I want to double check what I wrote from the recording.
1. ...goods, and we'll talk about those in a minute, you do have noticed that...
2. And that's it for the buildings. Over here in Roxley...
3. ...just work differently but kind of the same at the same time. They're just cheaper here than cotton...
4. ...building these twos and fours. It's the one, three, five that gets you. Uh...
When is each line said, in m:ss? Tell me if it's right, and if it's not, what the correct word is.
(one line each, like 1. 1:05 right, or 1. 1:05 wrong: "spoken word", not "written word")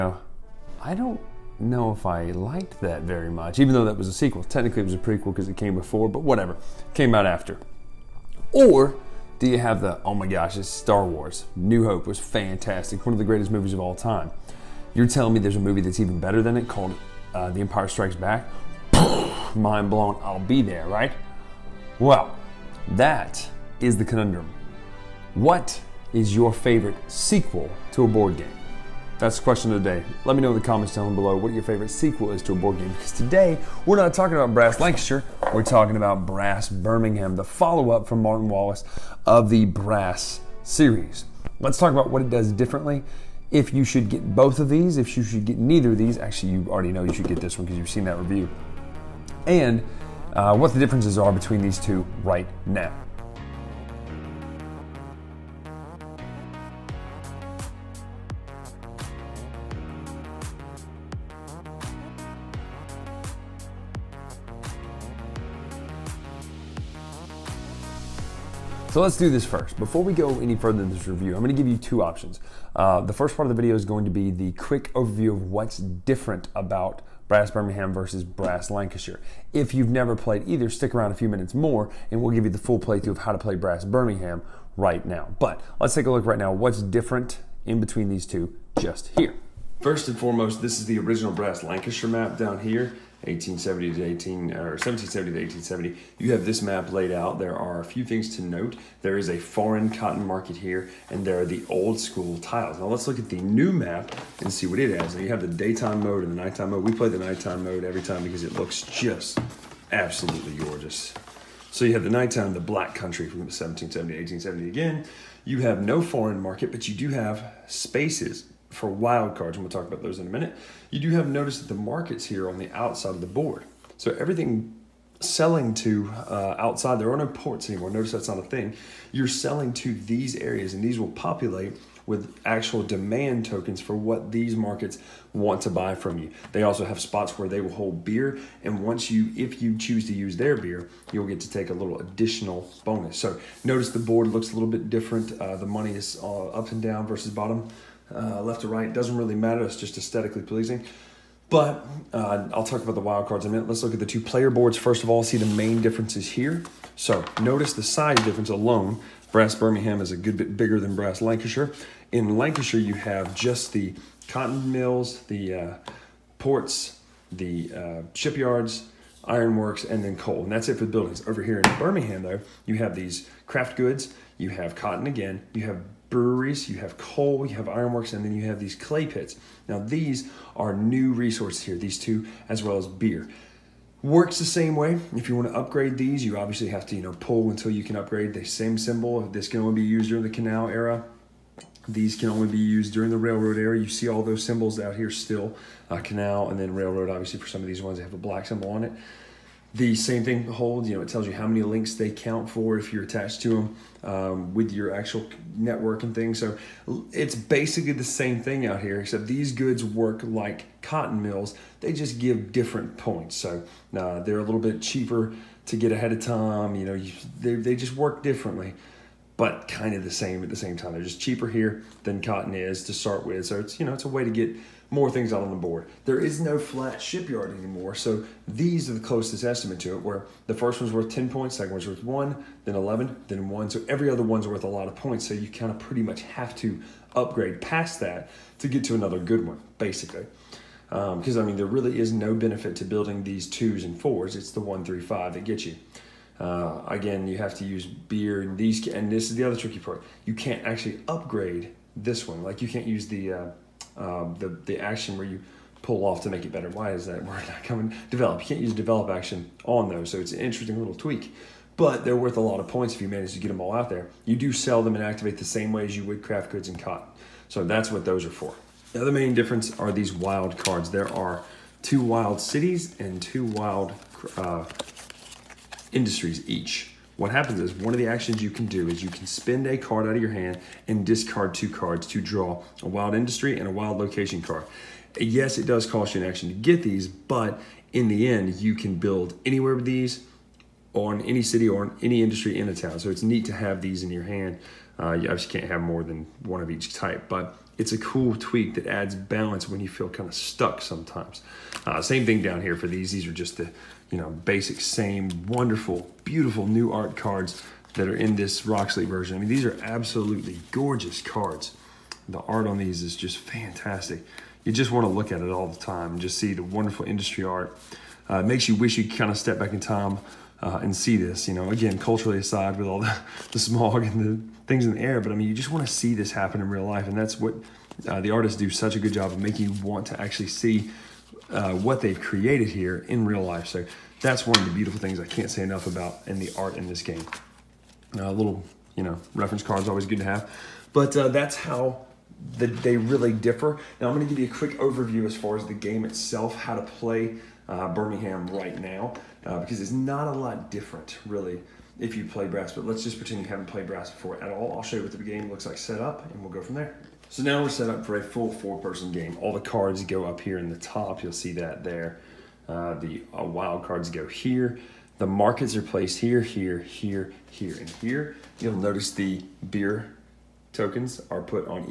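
1. 1:58 wrong: "wildcards", not "goods"
2. 2:50 wrong: "Birmingham", not "Roxley"
3. 3:37 right
4. 4:02 right.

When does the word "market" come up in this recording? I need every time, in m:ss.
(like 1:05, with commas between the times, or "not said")
1:40, 1:56, 2:01, 2:14, 6:05.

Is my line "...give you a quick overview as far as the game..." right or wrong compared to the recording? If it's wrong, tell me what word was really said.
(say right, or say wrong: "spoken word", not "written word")
right.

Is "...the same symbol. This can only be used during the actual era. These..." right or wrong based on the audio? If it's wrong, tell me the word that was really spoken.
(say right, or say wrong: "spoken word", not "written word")
wrong: "canal", not "actual".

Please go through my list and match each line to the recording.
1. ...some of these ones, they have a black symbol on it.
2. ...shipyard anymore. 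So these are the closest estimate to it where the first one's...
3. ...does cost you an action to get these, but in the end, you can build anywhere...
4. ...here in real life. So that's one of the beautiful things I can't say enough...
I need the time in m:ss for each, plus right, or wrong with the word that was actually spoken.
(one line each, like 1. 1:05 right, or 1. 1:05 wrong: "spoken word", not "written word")
1. 3:17 right
2. 3:47 right
3. 4:45 right
4. 5:32 right.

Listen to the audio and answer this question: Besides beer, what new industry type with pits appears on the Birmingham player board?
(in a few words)
clay pits.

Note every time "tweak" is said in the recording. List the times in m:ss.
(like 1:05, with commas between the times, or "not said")
4:20, 4:58.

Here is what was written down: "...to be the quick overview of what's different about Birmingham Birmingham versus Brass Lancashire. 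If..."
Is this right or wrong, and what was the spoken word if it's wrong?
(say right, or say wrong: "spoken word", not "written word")
wrong: "Brass", not "Birmingham".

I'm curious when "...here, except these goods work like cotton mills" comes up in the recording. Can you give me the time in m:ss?
3:28.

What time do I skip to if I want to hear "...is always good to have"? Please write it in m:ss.
5:39.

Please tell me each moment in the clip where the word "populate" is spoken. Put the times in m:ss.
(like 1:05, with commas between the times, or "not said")
2:11.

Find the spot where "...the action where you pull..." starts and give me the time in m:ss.
4:14.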